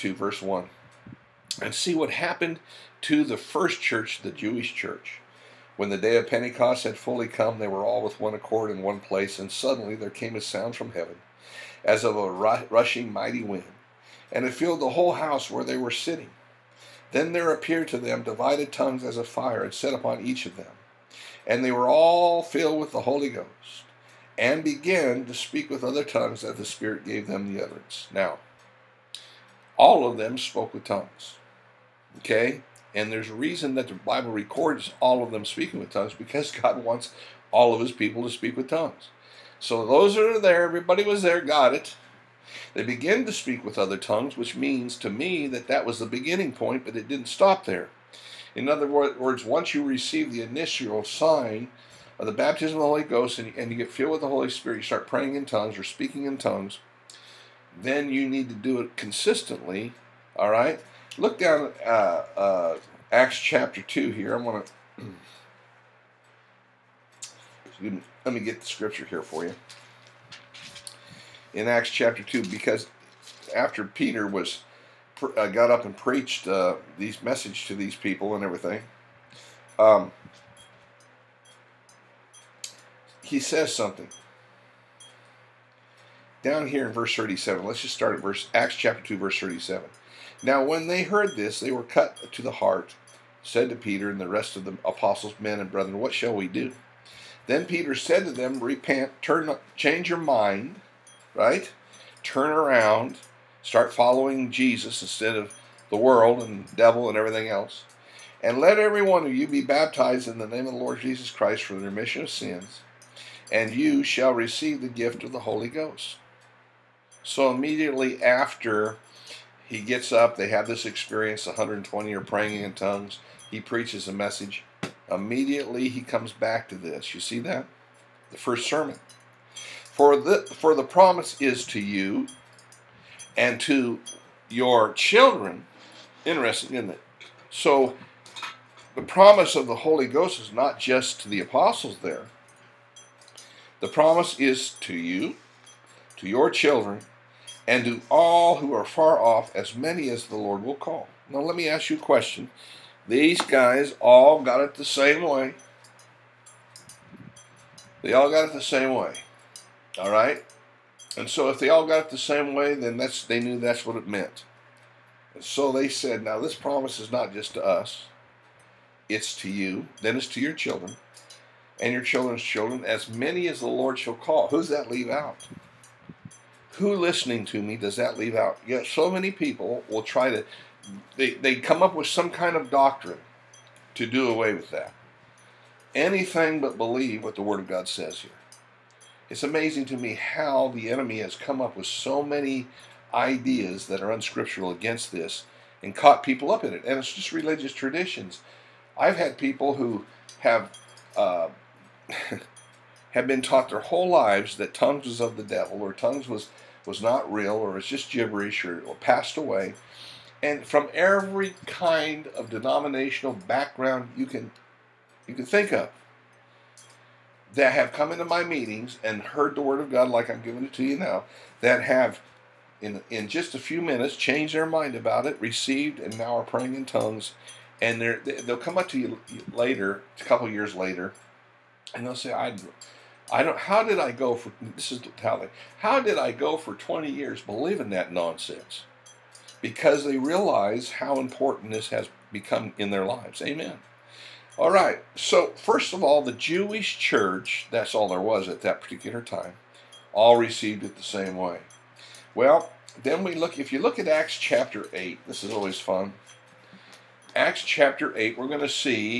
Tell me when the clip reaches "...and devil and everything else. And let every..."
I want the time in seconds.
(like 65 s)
106 s.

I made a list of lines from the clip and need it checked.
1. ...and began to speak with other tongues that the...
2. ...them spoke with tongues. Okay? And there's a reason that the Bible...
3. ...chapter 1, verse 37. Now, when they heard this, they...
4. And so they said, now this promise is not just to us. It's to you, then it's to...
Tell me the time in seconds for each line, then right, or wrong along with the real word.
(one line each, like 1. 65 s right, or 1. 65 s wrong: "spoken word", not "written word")
1. 24 s right
2. 30 s right
3. 88 s wrong: "2", not "1"
4. 165 s right.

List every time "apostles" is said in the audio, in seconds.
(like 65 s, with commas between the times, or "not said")
94 s, 141 s.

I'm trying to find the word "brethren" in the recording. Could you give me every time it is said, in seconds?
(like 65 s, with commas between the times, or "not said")
95 s.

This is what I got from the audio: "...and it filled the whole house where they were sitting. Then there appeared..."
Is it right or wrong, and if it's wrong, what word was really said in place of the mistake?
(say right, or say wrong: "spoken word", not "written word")
right.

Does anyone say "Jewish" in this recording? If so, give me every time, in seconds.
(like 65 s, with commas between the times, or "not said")
4 s, 246 s.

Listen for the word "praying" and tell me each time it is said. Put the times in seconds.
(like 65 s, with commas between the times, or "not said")
55 s, 122 s, 226 s.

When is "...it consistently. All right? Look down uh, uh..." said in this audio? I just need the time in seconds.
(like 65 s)
58 s.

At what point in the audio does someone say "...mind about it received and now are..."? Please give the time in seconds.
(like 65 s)
224 s.